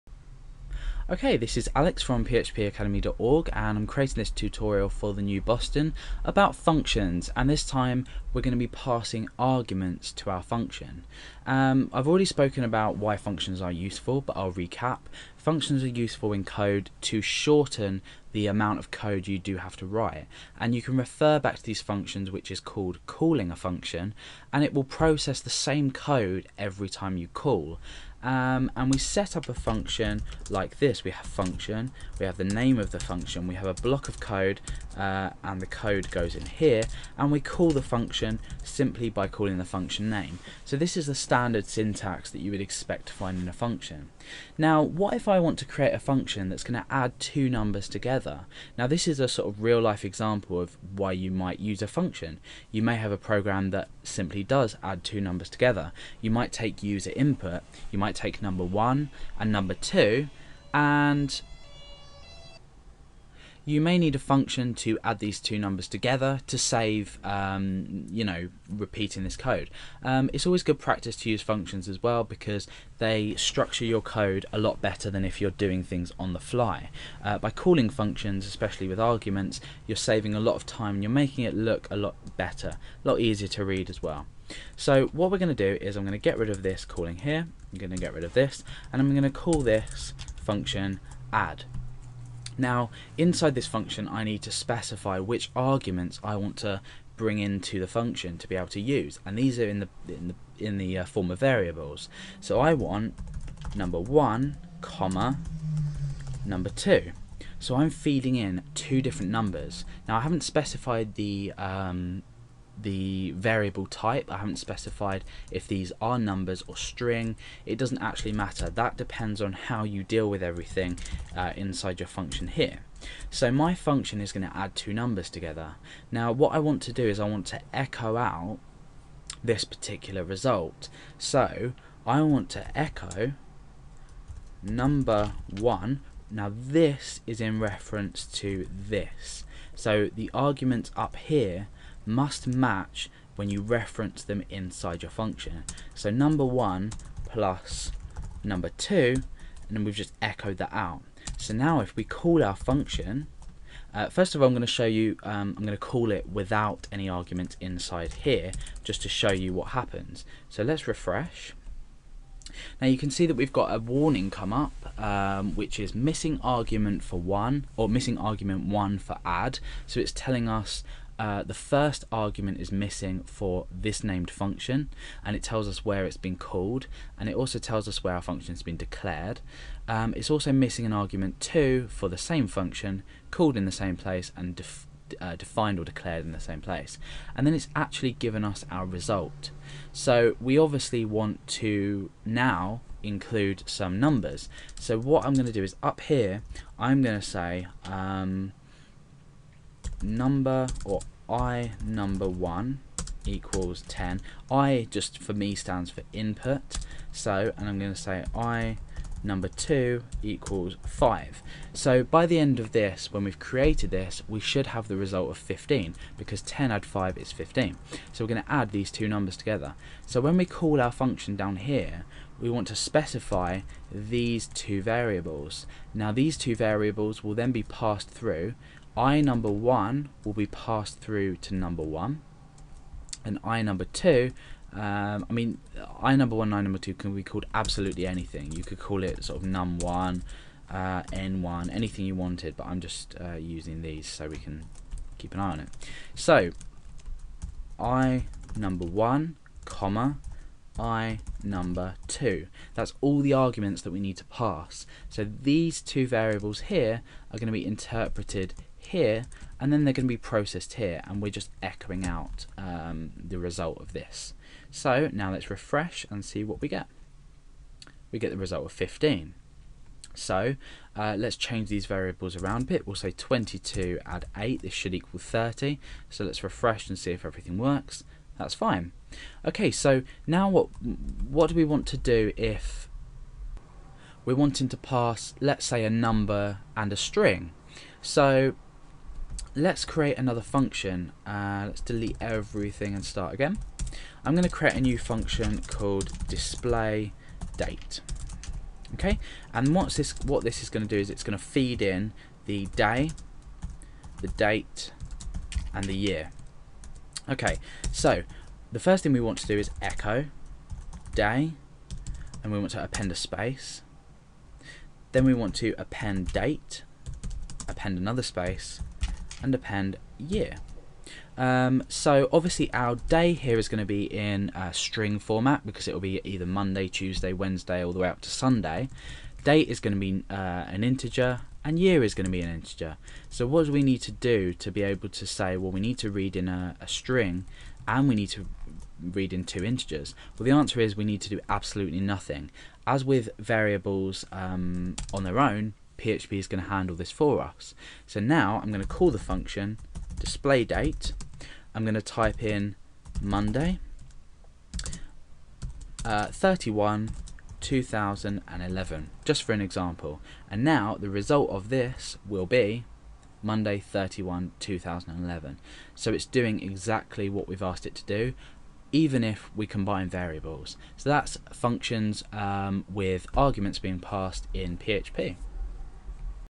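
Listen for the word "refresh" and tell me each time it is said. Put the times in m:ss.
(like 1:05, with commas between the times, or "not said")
2:40, 4:25, 4:36.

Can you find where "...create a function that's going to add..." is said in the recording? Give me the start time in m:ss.
0:45.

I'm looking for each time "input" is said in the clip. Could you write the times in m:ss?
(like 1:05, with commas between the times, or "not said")
0:57, 3:26.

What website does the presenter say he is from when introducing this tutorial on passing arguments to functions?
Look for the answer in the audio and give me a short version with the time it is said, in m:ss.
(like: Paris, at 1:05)
phpacademy.org, at 0:02.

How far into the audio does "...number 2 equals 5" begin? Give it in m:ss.
3:29.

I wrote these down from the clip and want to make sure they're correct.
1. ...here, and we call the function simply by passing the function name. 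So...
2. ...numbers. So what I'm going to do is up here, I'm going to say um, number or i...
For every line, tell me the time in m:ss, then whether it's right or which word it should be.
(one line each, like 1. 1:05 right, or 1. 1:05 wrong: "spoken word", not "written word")
1. 0:36 wrong: "calling", not "passing"
2. 3:13 right.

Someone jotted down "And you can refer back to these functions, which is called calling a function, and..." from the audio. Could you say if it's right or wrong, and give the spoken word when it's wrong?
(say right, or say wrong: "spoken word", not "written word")
right.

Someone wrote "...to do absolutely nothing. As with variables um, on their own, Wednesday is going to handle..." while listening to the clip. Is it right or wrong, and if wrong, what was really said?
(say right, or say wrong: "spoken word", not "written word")
wrong: "PHP", not "Wednesday".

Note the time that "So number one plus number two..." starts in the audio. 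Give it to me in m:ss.
2:25.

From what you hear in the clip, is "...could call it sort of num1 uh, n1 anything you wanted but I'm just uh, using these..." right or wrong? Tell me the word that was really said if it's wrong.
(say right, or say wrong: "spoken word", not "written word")
right.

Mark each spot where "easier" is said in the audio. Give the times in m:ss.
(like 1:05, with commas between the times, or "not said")
1:23.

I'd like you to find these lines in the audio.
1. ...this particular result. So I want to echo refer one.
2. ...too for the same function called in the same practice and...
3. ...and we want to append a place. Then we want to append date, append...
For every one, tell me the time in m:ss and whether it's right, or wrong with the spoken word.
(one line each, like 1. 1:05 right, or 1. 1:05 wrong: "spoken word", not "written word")
1. 2:09 wrong: "number", not "refer"
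2. 3:01 wrong: "place", not "practice"
3. 5:12 wrong: "space", not "place".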